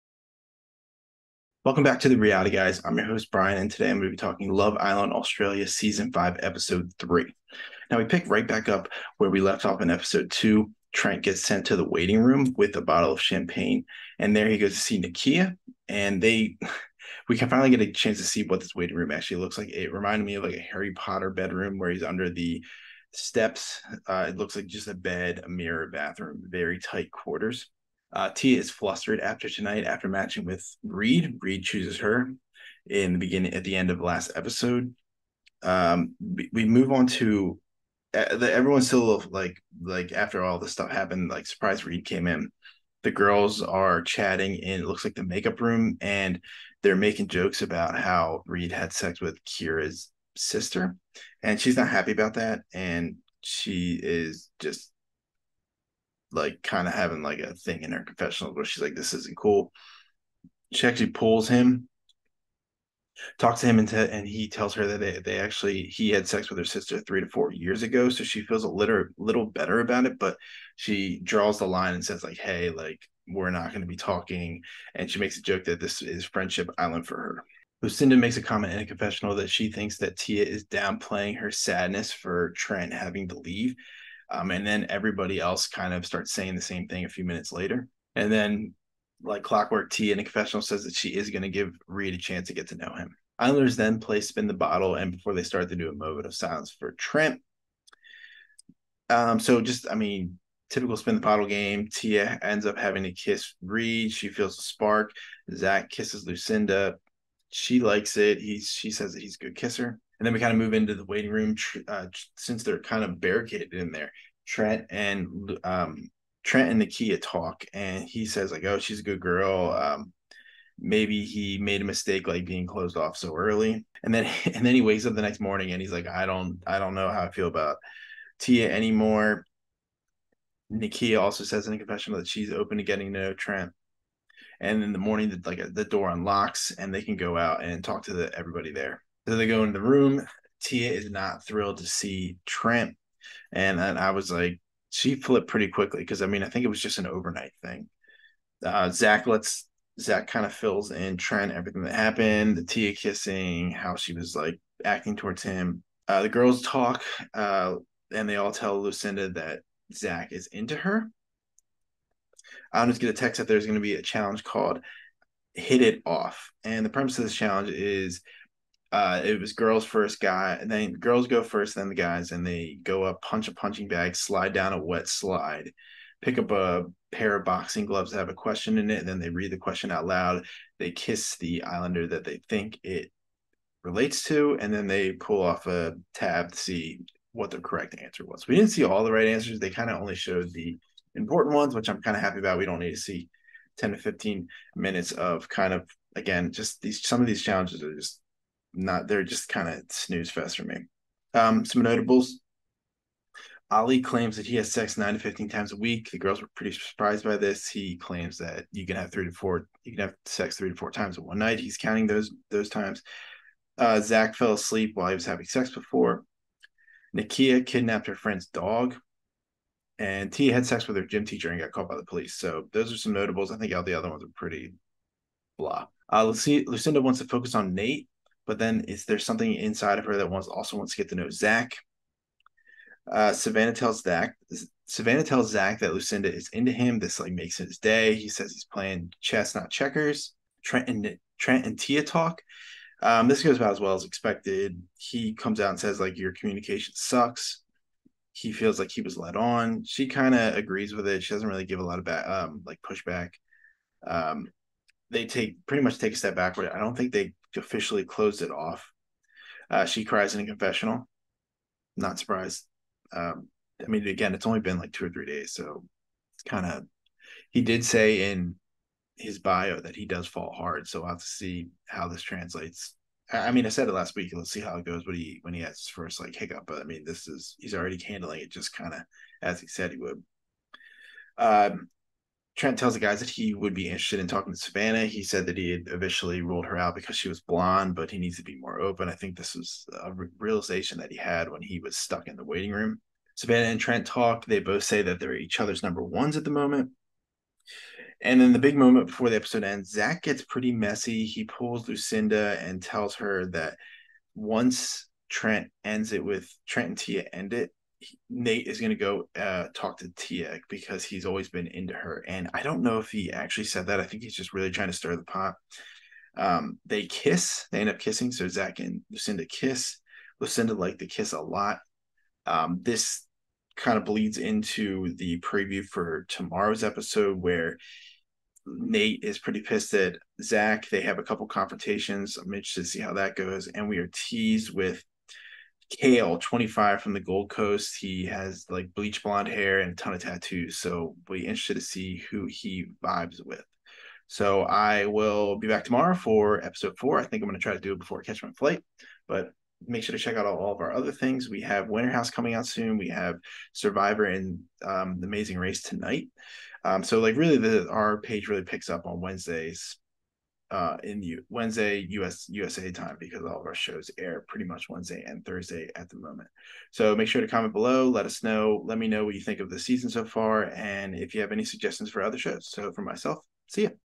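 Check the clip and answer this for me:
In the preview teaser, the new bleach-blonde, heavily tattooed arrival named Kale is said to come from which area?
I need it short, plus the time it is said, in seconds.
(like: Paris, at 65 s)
Gold Coast, at 337 s.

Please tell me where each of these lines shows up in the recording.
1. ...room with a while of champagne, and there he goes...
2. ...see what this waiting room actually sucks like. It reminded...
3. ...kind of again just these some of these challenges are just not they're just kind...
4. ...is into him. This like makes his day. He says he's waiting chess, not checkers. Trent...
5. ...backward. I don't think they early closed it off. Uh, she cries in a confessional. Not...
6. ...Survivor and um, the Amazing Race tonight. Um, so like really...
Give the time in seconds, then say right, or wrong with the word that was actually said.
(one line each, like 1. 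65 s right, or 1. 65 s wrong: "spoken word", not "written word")
1. 12 s wrong: "bottle", not "while"
2. 18 s wrong: "looks", not "sucks"
3. 195 s right
4. 236 s wrong: "playing", not "waiting"
5. 256 s wrong: "officially", not "early"
6. 353 s right.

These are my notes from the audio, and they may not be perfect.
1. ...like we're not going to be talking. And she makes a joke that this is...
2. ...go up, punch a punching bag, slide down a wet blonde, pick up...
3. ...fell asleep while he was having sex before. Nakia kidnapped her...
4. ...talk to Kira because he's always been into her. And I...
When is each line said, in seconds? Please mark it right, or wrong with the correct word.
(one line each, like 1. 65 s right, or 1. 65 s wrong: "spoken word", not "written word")
1. 72 s right
2. 172 s wrong: "slide", not "blonde"
3. 214 s right
4. 309 s wrong: "Tiek", not "Kira".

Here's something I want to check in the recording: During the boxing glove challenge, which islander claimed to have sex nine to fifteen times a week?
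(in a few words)
Ali.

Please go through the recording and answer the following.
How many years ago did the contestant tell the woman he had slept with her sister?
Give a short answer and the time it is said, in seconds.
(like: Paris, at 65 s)
3 to 4 years, at 67 s.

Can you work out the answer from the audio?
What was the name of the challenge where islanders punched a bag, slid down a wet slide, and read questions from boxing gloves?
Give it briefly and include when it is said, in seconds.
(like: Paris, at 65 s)
Hit It Off, at 165 s.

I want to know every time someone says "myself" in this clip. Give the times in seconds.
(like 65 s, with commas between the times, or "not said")
373 s.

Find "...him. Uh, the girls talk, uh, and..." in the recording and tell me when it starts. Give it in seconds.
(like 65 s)
155 s.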